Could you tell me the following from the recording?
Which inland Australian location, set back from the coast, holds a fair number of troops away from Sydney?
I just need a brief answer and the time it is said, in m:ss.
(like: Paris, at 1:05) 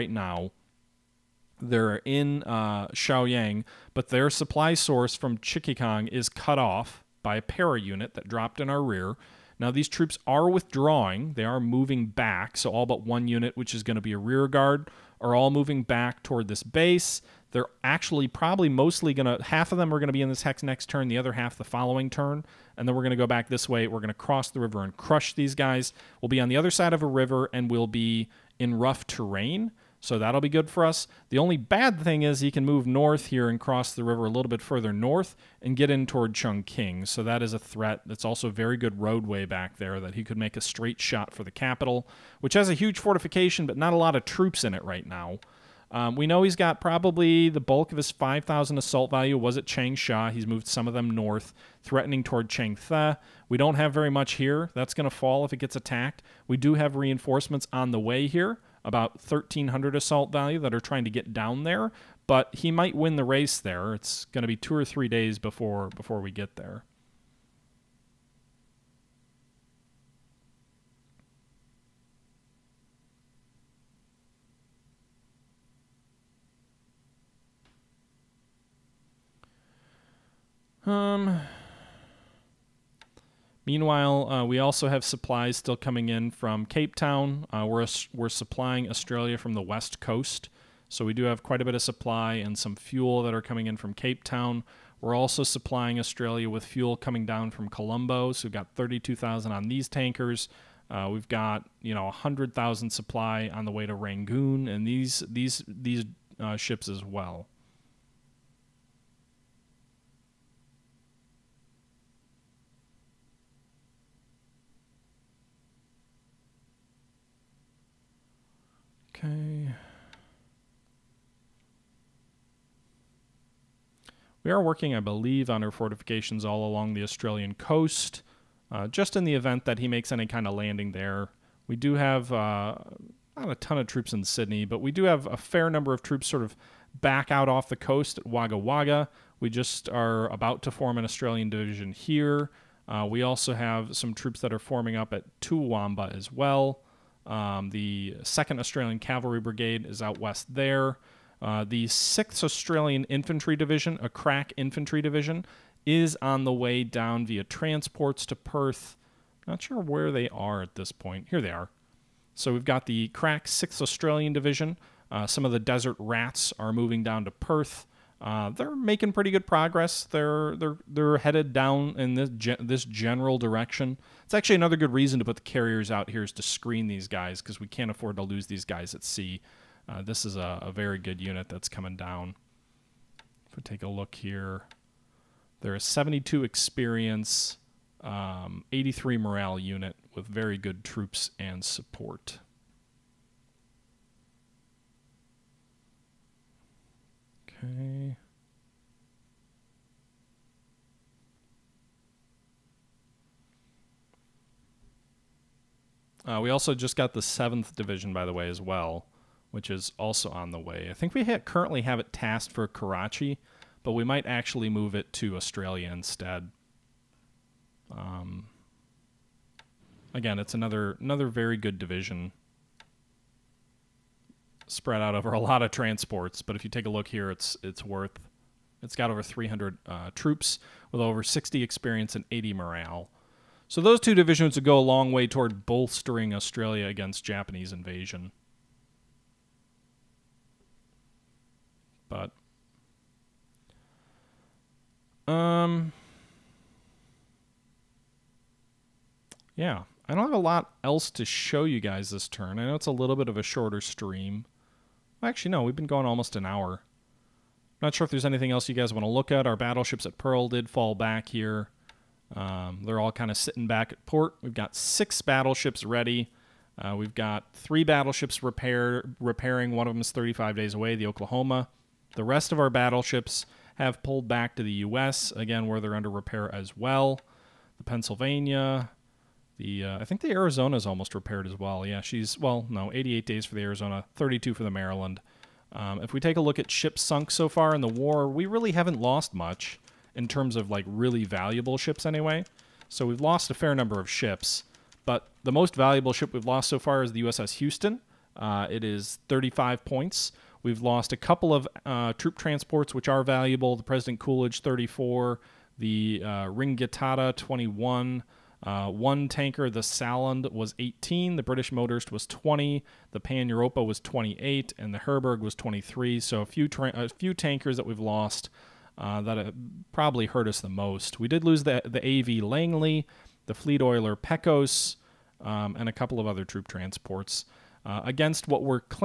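Wagga Wagga, at 2:18.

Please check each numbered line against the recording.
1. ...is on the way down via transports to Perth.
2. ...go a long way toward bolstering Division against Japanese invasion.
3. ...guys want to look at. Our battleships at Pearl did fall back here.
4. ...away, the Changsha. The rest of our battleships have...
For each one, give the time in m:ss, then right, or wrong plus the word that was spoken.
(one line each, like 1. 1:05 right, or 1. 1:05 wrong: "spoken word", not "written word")
1. 2:35 right
2. 3:54 wrong: "Australia", not "Division"
3. 4:18 right
4. 4:30 wrong: "Oklahoma", not "Changsha".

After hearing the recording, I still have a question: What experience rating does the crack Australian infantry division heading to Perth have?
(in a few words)
72.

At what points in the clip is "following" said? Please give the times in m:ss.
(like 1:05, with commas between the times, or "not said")
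0:21.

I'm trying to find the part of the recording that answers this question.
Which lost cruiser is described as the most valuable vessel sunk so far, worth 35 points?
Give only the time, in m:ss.
4:57.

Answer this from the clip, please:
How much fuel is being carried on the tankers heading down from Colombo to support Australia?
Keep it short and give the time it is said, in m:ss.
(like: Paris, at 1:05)
32,000, at 1:38.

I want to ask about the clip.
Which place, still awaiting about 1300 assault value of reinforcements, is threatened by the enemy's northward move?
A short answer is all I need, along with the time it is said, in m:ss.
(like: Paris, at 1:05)
Changteh, at 0:52.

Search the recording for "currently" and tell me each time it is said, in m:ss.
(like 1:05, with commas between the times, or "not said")
3:31.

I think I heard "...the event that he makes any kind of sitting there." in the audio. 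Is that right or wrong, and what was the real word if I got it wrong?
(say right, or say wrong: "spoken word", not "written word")
wrong: "landing", not "sitting".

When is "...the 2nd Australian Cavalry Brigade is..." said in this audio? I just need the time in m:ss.
2:27.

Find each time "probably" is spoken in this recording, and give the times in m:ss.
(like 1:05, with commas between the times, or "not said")
0:18, 0:46, 5:19.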